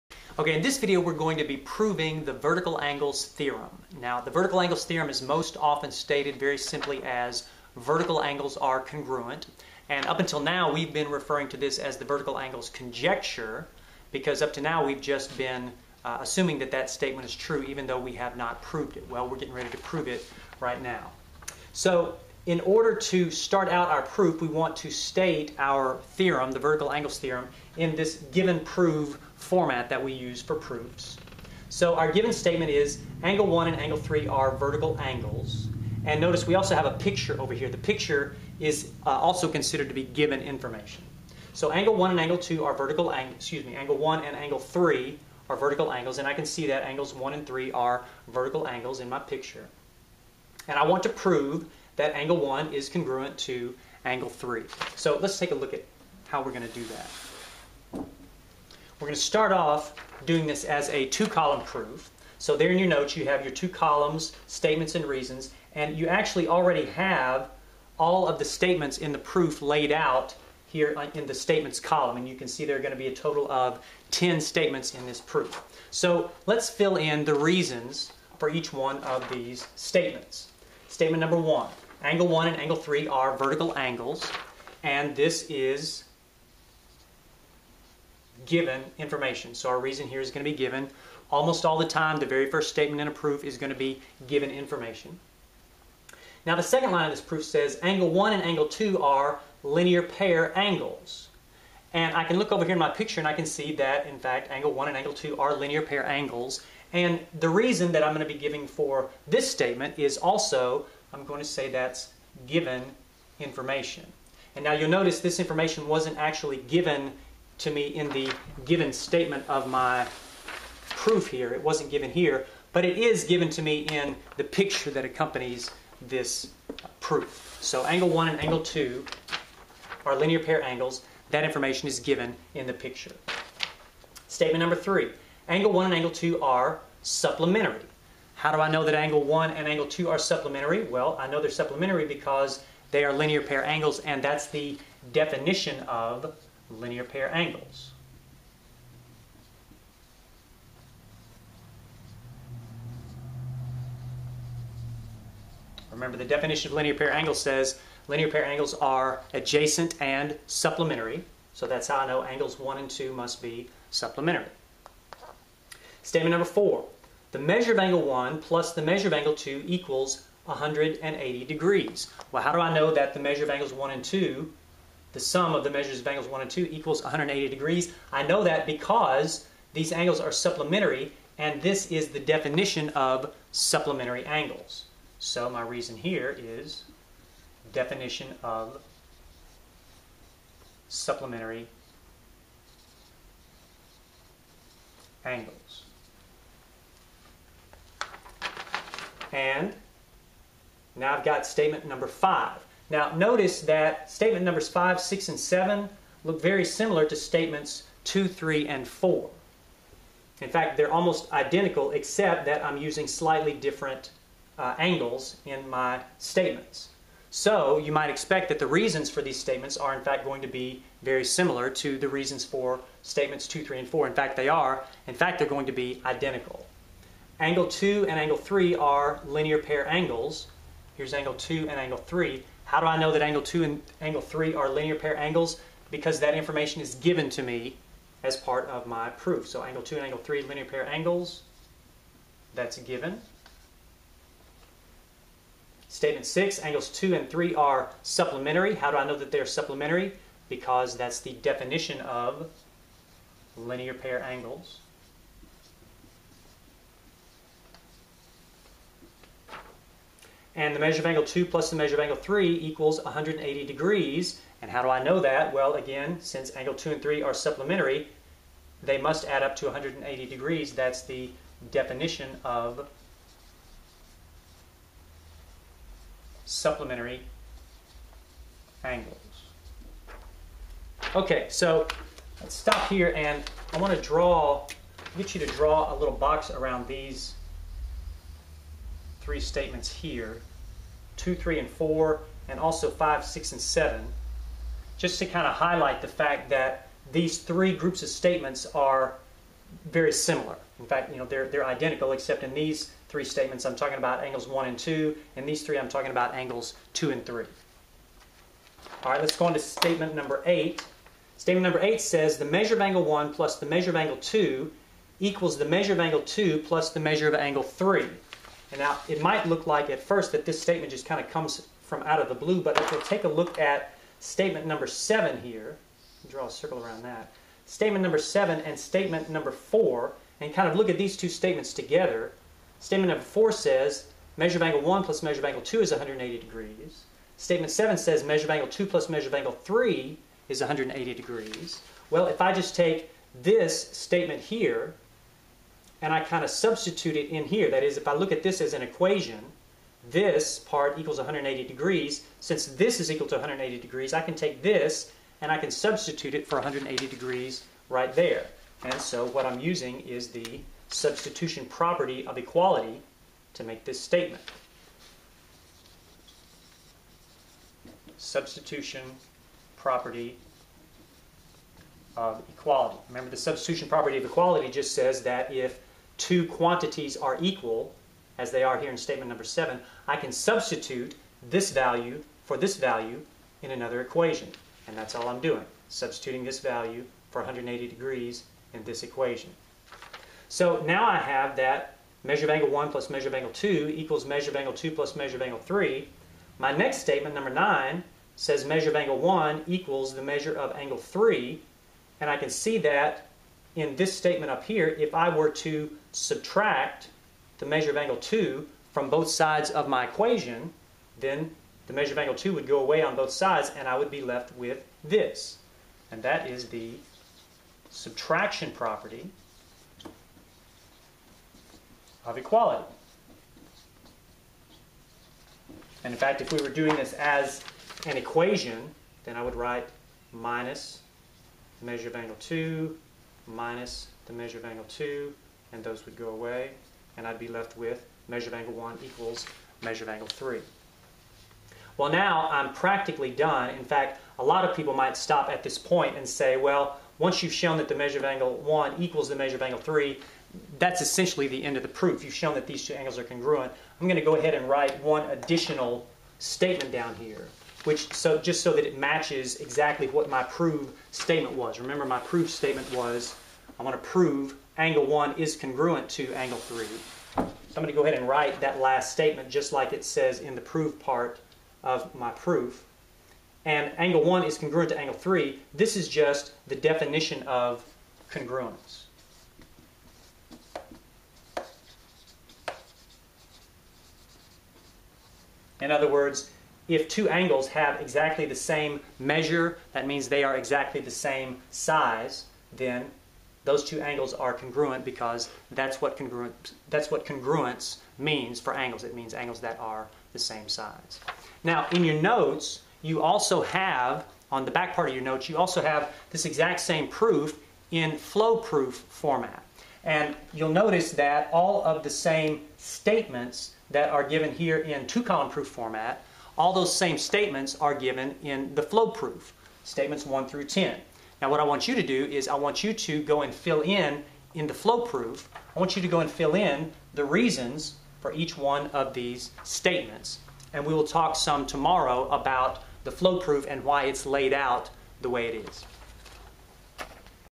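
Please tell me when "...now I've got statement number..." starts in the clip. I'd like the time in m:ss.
3:20.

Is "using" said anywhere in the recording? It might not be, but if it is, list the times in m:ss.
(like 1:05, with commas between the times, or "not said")
3:32, 5:59.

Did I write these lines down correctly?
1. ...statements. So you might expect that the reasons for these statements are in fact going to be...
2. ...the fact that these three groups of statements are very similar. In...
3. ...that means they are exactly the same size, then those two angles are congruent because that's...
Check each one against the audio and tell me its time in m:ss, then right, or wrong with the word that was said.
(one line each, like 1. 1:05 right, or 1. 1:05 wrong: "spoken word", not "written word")
1. 3:36 right
2. 4:56 right
3. 8:09 right.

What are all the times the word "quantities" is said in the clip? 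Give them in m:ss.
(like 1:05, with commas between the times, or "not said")
6:16.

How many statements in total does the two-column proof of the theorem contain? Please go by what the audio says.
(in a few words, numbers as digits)
10.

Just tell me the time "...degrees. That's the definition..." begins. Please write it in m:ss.
4:30.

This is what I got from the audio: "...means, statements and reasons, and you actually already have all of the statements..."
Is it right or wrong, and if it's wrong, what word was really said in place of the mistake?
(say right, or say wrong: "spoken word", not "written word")
wrong: "columns", not "means".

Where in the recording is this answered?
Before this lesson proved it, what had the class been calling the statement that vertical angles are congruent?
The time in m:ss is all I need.
0:12.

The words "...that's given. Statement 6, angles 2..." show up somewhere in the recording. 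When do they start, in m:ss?
4:02.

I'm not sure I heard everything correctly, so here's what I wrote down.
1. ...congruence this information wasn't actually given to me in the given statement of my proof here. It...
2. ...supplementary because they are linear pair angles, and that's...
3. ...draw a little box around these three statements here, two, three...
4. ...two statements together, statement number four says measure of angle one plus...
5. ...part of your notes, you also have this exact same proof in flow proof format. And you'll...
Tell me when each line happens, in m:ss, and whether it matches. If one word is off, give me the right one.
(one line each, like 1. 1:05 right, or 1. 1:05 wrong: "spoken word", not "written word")
1. 1:54 wrong: "notice", not "congruence"
2. 2:21 right
3. 4:45 right
4. 5:31 right
5. 8:24 right.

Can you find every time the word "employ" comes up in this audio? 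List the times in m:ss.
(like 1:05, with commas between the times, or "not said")
not said.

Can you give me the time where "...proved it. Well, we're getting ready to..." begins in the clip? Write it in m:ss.
0:18.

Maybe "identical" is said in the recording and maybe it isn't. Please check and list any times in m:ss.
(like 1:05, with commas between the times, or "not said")
3:31, 3:46, 5:01.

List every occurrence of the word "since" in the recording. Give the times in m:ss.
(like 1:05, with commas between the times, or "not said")
4:26, 5:52.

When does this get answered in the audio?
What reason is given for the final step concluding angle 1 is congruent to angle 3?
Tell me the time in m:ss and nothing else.
7:56.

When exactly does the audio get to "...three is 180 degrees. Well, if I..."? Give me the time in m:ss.
5:39.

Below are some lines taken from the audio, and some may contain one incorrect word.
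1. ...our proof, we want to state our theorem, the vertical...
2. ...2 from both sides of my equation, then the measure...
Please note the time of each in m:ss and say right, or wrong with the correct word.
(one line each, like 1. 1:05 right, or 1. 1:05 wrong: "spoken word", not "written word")
1. 0:23 right
2. 6:48 right.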